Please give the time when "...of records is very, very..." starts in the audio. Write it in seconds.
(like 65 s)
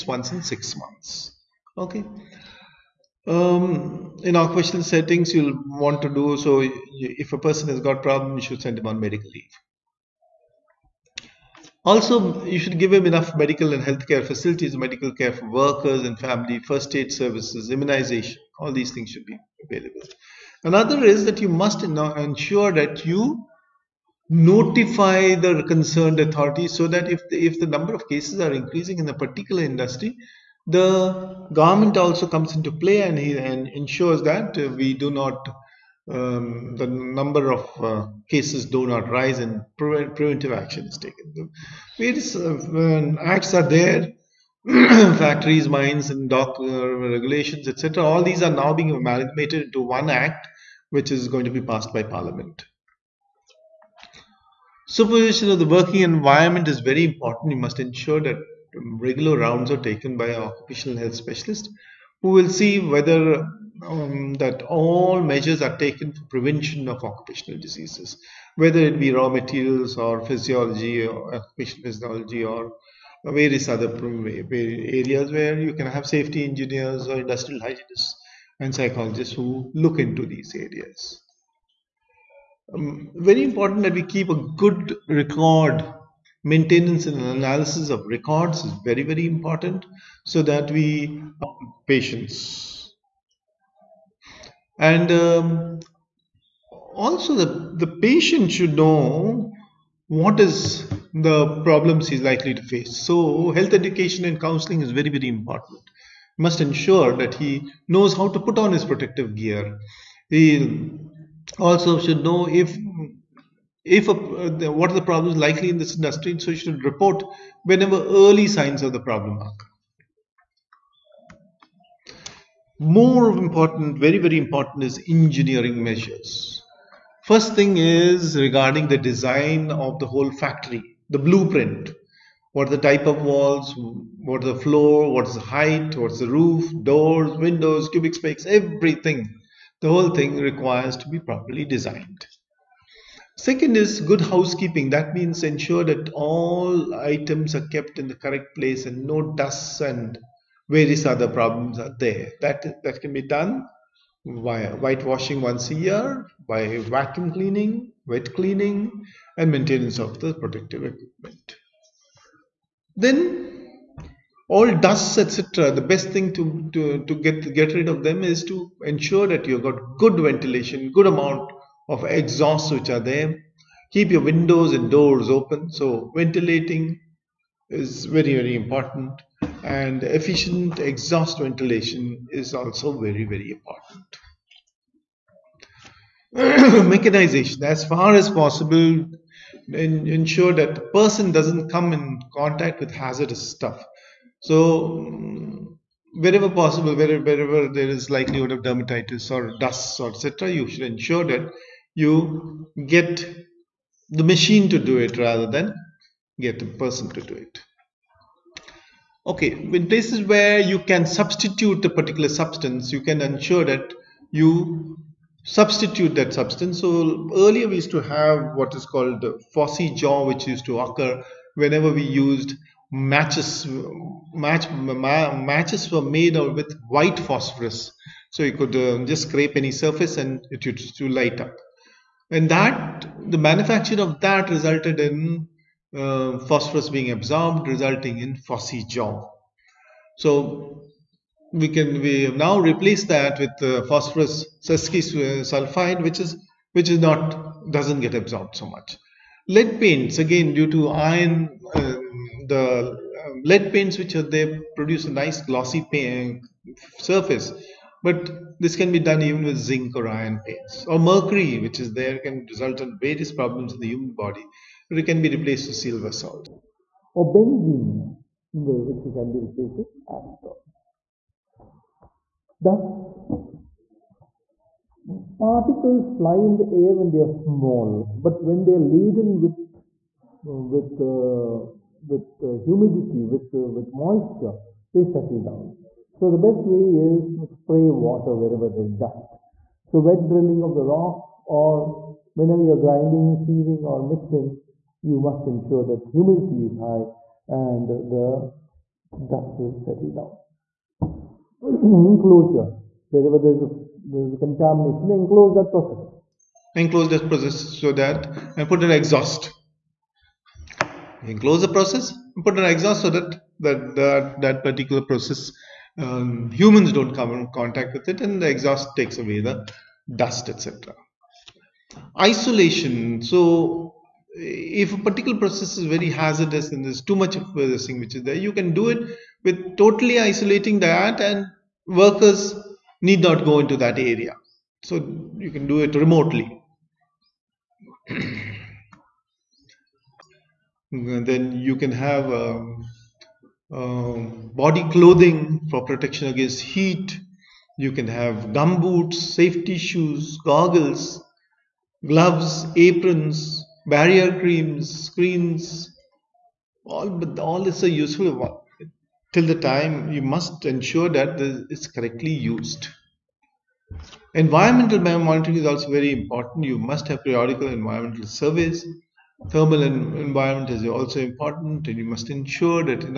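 87 s.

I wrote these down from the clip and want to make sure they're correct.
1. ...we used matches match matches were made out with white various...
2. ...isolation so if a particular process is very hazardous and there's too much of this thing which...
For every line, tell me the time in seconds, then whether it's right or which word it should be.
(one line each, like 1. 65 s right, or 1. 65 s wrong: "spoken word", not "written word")
1. 221 s wrong: "phosphorus", not "various"
2. 322 s right.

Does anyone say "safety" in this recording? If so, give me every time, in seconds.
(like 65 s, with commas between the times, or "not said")
76 s, 349 s.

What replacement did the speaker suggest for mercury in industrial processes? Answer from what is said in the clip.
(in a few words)
silver salts.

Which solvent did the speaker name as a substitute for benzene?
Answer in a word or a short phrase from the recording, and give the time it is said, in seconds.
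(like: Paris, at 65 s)
acetone, at 270 s.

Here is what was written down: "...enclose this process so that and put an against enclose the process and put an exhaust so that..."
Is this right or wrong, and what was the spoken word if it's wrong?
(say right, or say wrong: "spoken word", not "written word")
wrong: "exhaust", not "against".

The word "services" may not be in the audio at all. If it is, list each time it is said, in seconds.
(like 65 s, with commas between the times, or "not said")
17 s.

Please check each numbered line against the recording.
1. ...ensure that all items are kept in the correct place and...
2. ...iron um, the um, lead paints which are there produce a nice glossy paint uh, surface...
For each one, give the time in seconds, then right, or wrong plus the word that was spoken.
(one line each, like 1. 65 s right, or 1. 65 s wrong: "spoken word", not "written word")
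1. 145 s right
2. 250 s right.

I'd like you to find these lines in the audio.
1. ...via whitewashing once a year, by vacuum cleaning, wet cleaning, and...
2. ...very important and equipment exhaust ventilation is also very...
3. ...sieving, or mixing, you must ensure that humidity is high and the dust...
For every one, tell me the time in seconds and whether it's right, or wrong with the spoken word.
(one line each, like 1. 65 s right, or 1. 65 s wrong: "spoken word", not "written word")
1. 154 s right
2. 178 s wrong: "efficient", not "equipment"
3. 293 s right.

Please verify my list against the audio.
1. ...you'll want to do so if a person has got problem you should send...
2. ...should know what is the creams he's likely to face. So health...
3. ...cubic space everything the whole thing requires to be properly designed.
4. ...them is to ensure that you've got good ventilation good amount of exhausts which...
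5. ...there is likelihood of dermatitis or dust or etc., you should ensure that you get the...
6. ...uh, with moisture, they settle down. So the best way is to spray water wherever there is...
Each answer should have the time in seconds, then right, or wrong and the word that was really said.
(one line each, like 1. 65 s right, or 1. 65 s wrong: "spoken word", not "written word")
1. 5 s right
2. 98 s wrong: "problems", not "creams"
3. 137 s right
4. 168 s right
5. 197 s right
6. 283 s right.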